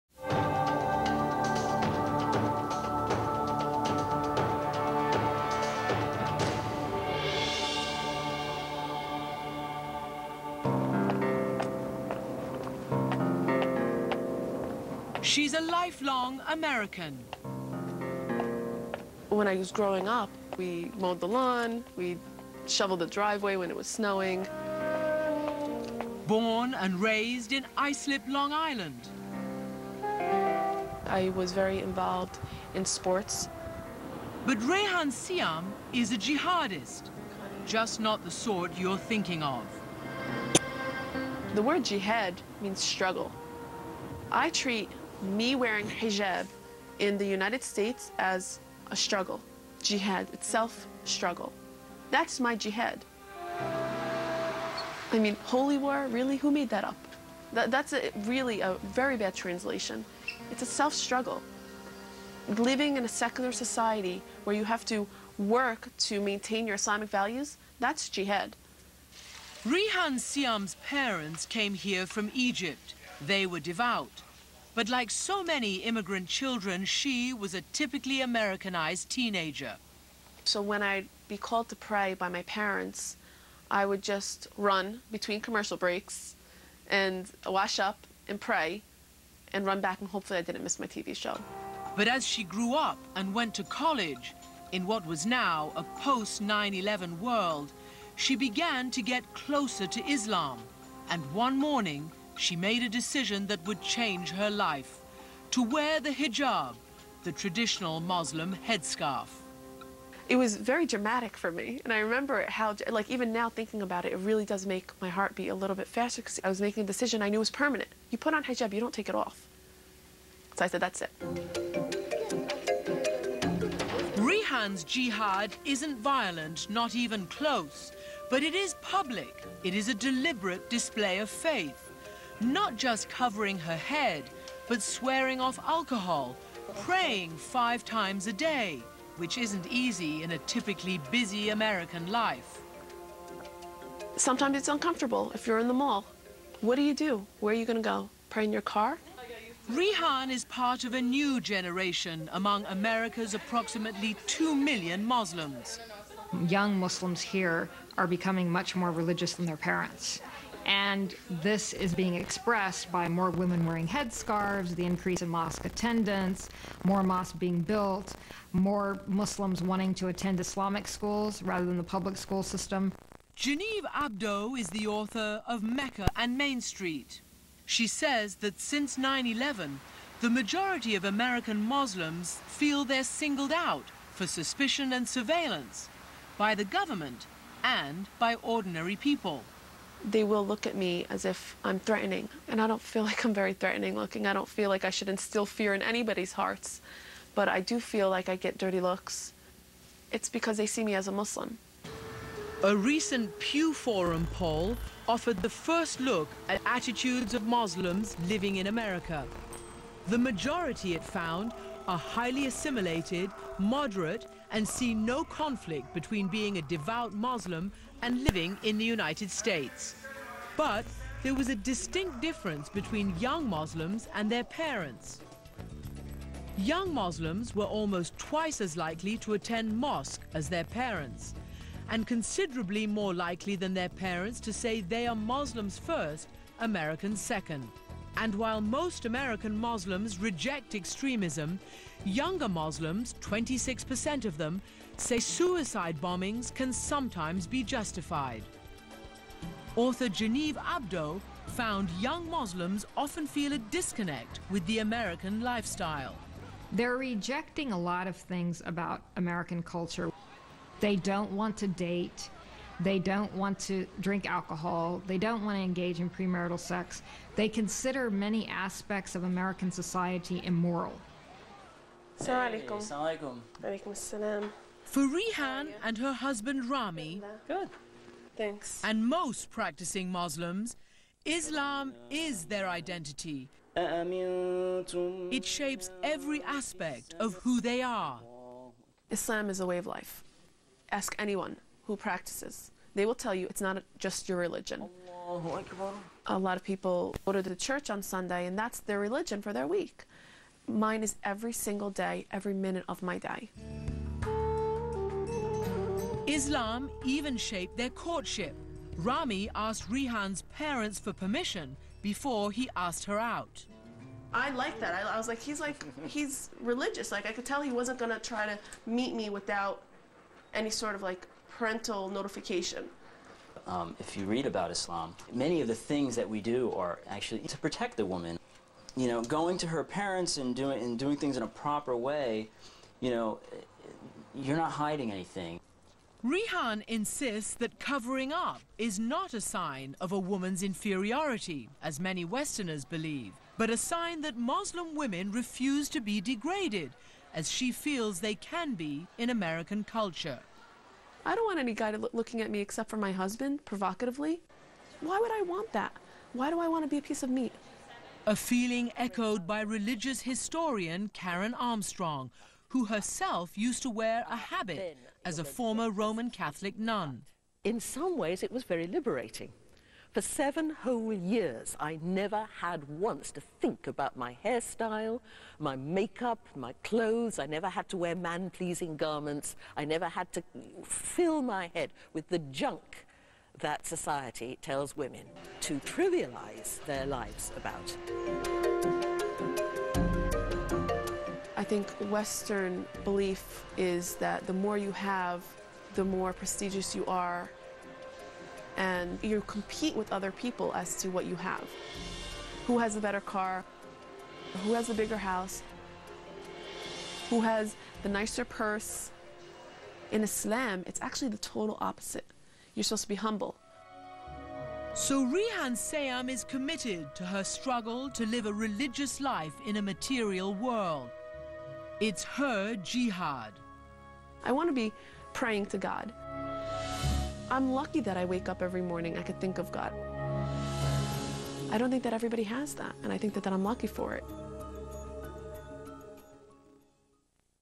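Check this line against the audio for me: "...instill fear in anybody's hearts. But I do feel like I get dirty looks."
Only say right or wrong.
right.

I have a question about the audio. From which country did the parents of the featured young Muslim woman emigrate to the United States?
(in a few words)
Egypt.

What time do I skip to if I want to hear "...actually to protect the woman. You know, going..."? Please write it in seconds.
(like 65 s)
327 s.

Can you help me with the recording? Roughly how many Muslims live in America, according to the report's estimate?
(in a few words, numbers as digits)
2 million.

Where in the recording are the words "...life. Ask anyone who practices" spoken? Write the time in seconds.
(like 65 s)
289 s.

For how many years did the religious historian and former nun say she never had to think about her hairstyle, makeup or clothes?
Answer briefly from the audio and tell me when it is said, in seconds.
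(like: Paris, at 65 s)
7, at 370 s.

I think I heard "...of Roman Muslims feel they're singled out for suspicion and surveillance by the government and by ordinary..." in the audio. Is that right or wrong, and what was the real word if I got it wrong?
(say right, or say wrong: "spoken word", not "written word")
wrong: "American", not "Roman".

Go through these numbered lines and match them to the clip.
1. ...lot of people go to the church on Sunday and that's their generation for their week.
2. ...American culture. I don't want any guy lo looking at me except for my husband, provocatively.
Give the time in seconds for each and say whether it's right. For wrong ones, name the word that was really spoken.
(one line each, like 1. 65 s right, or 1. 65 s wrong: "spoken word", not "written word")
1. 296 s wrong: "religion", not "generation"
2. 349 s right.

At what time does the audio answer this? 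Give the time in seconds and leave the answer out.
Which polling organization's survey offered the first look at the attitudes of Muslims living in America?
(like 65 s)
203 s.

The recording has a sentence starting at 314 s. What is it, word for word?
I, I, was like, he's like, he's religious.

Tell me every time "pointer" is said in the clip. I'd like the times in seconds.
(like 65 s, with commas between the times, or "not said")
not said.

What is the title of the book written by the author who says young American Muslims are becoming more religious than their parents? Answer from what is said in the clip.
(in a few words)
Mecca and Main Street.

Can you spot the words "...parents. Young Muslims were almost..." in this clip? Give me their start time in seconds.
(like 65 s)
224 s.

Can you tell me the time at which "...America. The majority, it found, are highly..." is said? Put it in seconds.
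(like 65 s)
208 s.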